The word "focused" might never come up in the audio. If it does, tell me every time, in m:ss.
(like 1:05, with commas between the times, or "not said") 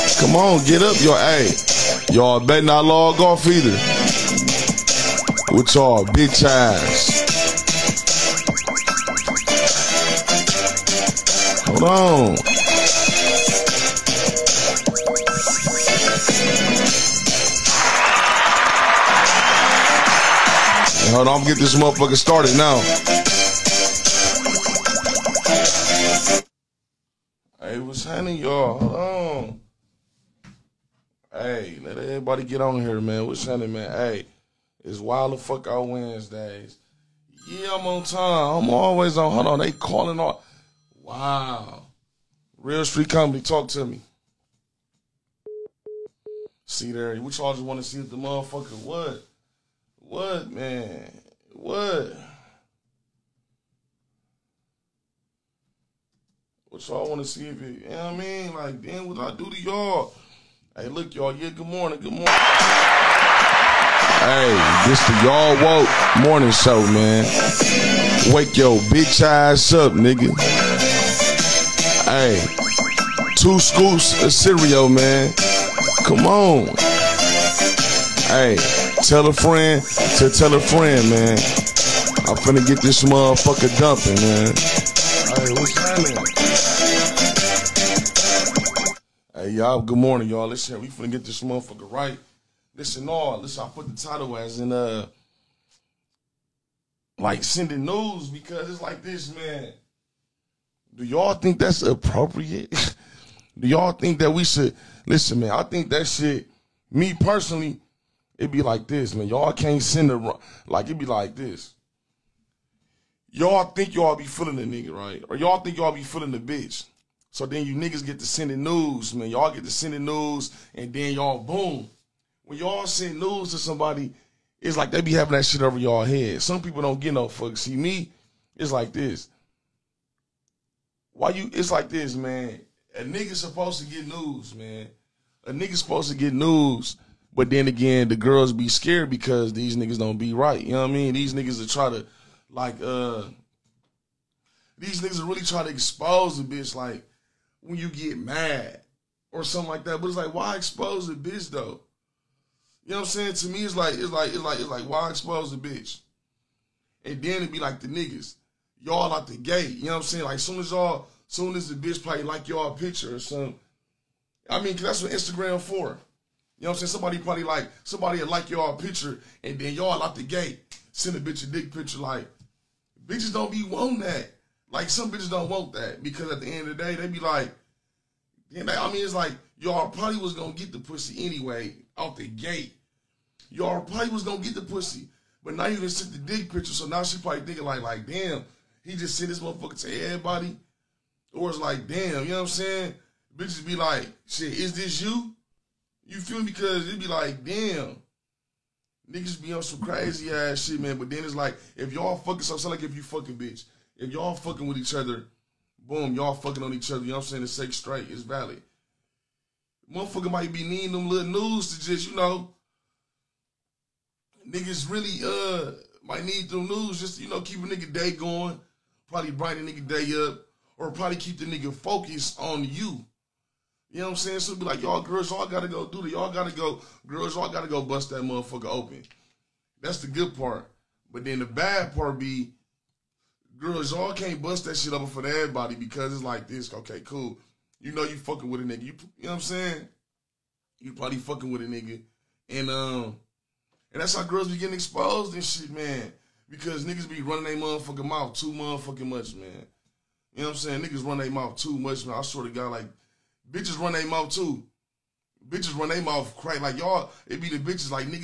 3:41.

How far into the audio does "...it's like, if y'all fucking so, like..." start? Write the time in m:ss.
3:21.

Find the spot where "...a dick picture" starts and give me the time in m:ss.
2:51.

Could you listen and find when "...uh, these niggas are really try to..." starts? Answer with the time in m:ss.
2:22.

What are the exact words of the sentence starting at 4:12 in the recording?
I swear to God, like bitches run their mouth too.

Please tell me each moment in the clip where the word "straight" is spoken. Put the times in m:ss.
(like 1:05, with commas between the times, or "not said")
3:27.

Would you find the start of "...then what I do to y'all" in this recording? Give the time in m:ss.
0:58.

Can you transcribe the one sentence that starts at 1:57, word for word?
So then you niggas get to sending news, man.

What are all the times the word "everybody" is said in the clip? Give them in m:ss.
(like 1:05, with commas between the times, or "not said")
3:10, 3:55.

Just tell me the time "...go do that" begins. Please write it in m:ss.
3:45.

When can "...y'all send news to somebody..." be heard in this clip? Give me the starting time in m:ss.
2:02.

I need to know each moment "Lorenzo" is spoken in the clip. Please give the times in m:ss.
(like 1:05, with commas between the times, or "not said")
not said.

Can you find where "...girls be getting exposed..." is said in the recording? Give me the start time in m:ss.
4:04.